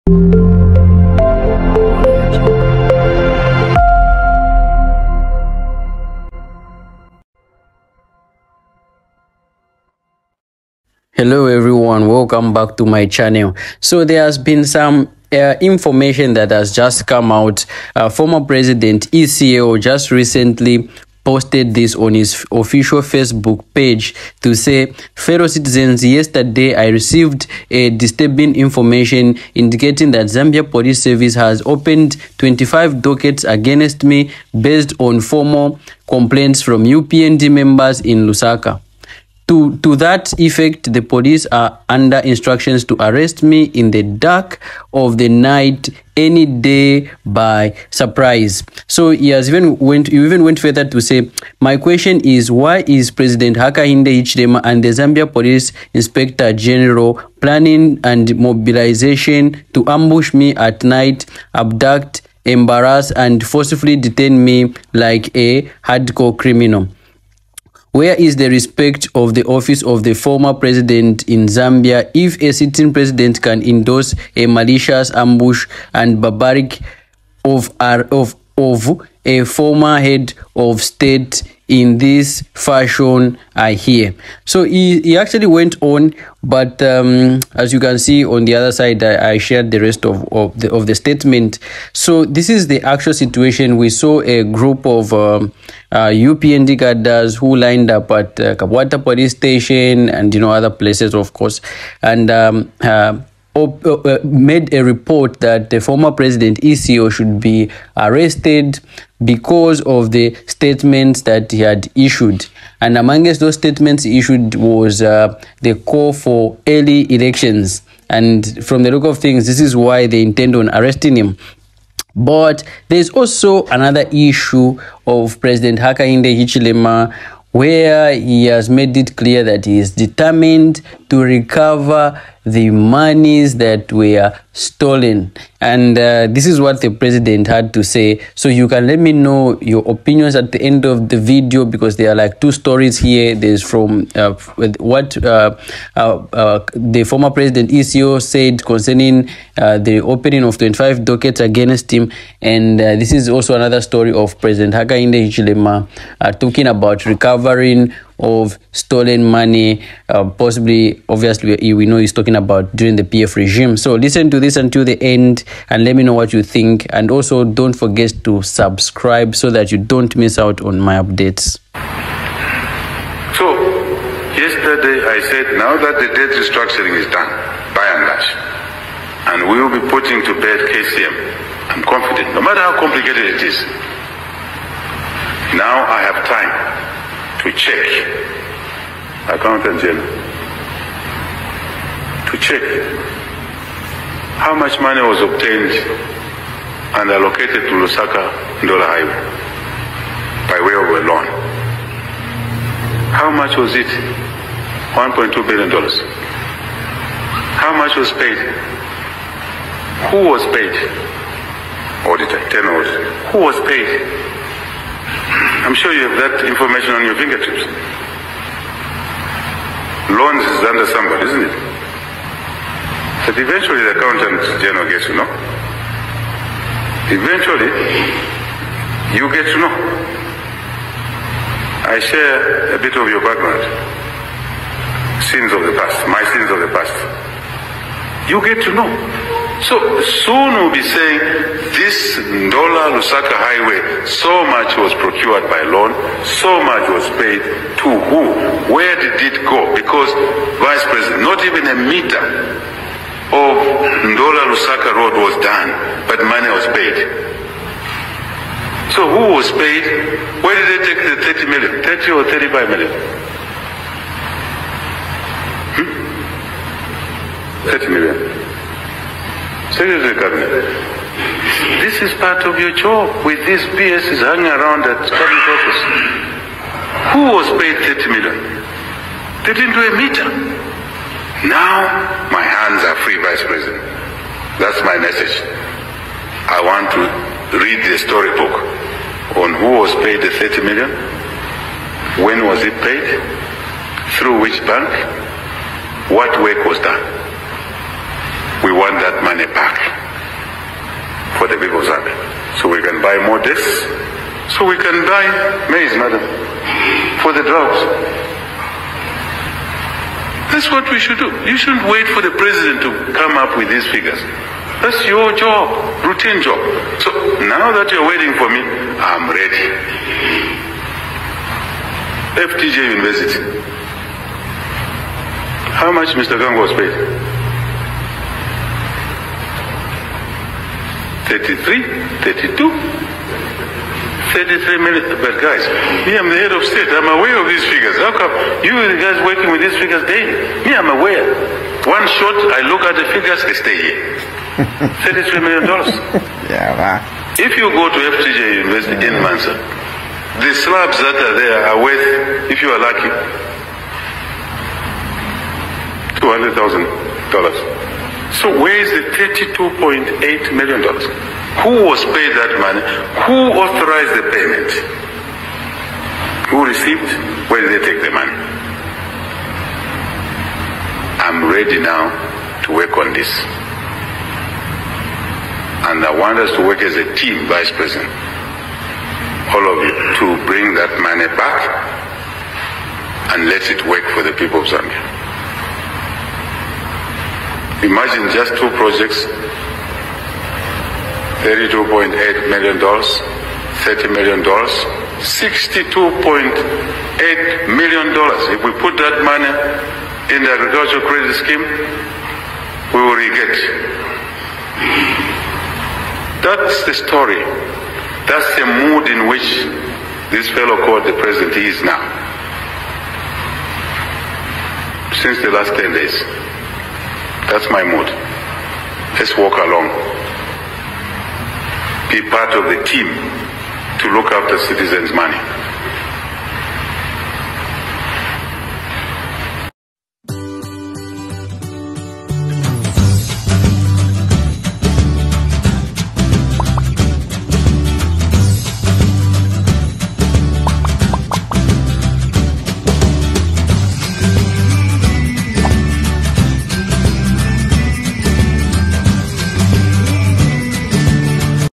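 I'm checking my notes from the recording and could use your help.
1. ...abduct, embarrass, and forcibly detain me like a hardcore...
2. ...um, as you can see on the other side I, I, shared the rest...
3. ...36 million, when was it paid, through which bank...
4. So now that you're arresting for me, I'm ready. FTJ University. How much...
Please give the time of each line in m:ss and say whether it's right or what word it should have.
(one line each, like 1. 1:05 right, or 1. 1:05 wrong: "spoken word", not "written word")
1. 1:01 right
2. 1:26 right
3. 4:50 wrong: "30", not "36"
4. 5:17 wrong: "waiting", not "arresting".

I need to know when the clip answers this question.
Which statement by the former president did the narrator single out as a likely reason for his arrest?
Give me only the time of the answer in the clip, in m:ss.
1:55.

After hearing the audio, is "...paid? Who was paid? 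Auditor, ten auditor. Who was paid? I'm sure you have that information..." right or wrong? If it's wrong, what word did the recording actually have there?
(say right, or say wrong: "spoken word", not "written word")
right.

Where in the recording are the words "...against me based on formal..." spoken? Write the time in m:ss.
0:33.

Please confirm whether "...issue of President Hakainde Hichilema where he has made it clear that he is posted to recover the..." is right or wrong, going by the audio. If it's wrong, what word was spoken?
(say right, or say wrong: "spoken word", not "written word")
wrong: "determined", not "posted".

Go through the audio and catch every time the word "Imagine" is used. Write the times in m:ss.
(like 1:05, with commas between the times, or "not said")
6:27.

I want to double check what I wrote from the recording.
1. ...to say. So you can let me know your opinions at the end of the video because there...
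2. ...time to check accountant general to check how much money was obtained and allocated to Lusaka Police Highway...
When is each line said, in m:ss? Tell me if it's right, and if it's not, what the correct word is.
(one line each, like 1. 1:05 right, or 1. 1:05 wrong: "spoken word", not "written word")
1. 2:17 right
2. 3:06 wrong: "Ndola", not "Police".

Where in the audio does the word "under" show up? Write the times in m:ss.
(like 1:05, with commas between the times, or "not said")
0:41, 3:40.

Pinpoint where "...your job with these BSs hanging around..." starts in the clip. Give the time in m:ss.
4:32.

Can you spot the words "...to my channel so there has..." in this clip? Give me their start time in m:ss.
0:12.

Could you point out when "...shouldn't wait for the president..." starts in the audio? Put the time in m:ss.
5:11.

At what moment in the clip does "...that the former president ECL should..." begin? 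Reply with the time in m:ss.
1:45.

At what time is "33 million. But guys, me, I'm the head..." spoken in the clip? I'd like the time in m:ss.
5:32.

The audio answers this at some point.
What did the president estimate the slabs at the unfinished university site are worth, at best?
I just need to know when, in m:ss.
5:56.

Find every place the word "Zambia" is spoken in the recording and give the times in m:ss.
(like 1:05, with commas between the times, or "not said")
0:30, 0:54, 1:11, 6:24.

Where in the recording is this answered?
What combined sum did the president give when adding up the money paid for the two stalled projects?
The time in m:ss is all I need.
6:34.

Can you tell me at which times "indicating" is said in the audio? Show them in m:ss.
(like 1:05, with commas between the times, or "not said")
0:29.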